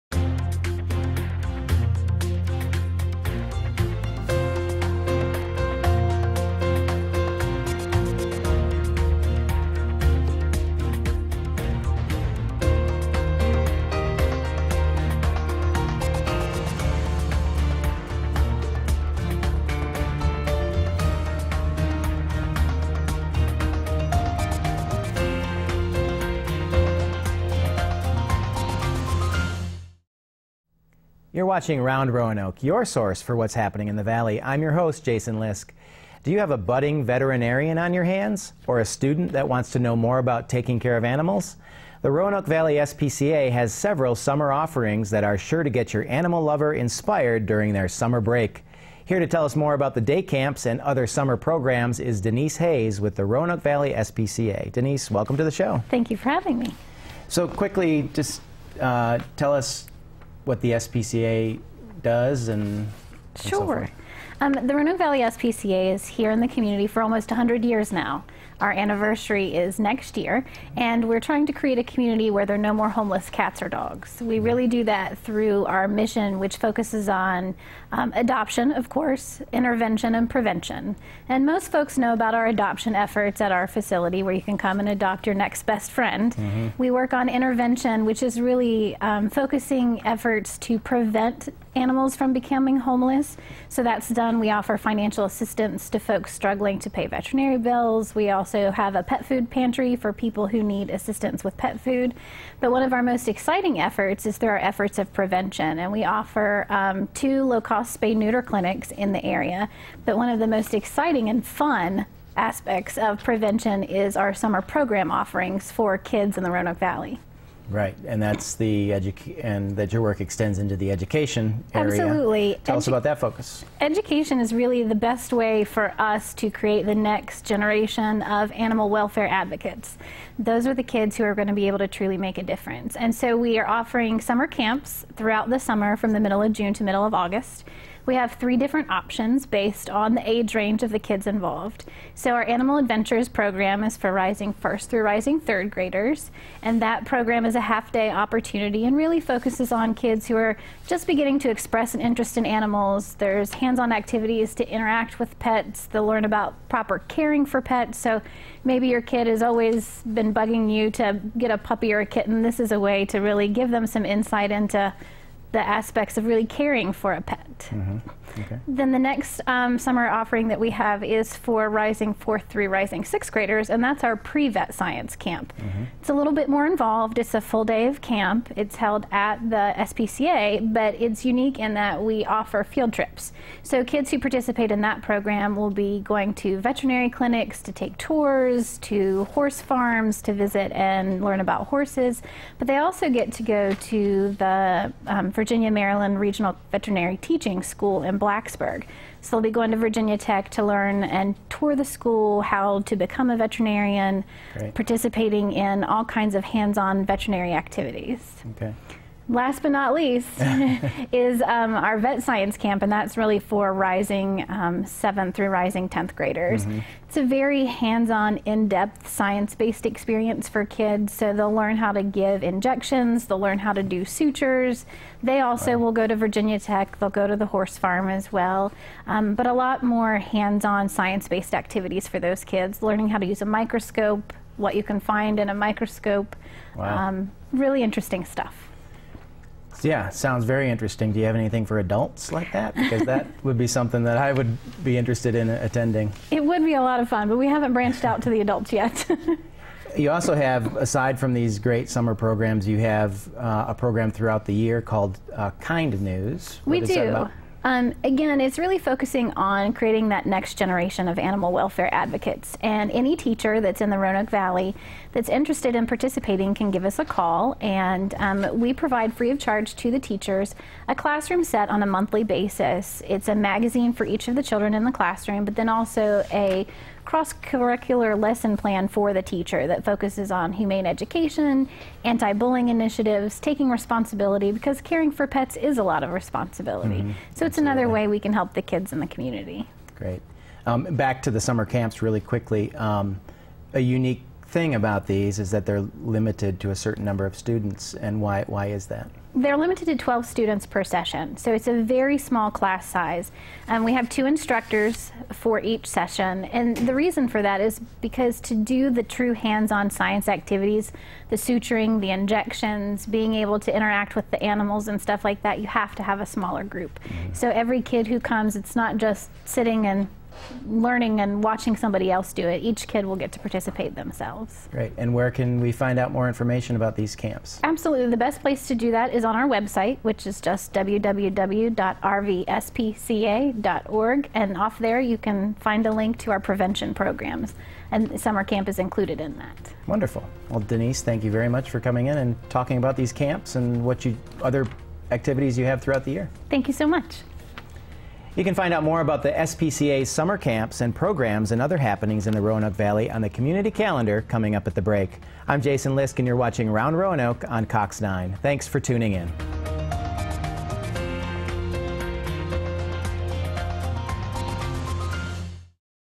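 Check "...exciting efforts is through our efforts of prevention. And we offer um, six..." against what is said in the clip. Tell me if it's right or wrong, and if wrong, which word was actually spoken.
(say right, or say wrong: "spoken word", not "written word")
wrong: "two", not "six".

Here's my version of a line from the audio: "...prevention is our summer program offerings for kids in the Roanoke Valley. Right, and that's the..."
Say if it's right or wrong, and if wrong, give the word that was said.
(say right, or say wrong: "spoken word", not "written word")
right.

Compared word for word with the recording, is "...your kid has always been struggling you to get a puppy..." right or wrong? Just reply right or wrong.
wrong.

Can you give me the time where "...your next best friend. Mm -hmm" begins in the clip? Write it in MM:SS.
01:25.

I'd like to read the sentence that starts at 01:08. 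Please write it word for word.
Our anniversary is next year, and we're trying to create a community where there are no more homeless cats or dogs.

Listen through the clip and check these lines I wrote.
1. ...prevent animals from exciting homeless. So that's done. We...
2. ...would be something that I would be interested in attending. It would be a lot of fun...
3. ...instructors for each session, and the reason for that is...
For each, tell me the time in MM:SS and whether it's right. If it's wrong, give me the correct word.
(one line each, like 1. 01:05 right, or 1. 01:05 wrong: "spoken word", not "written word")
1. 01:30 wrong: "becoming", not "exciting"
2. 04:03 right
3. 05:04 right.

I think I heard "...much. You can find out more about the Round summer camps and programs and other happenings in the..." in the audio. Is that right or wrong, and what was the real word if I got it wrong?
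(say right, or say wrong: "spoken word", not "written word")
wrong: "SPCA", not "Round".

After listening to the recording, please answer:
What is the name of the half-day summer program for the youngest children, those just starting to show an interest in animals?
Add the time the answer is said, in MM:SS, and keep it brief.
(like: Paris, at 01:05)
Animal Adventures, at 02:22.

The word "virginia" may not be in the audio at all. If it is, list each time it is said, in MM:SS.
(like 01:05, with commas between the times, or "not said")
03:15, 03:19, 03:46.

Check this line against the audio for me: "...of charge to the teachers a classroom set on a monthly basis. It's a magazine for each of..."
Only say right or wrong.
right.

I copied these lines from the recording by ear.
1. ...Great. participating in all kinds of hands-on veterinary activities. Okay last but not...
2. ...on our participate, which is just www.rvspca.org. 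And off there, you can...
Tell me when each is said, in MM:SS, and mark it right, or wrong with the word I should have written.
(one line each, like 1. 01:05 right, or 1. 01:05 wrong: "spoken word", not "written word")
1. 03:24 right
2. 05:29 wrong: "website", not "participate".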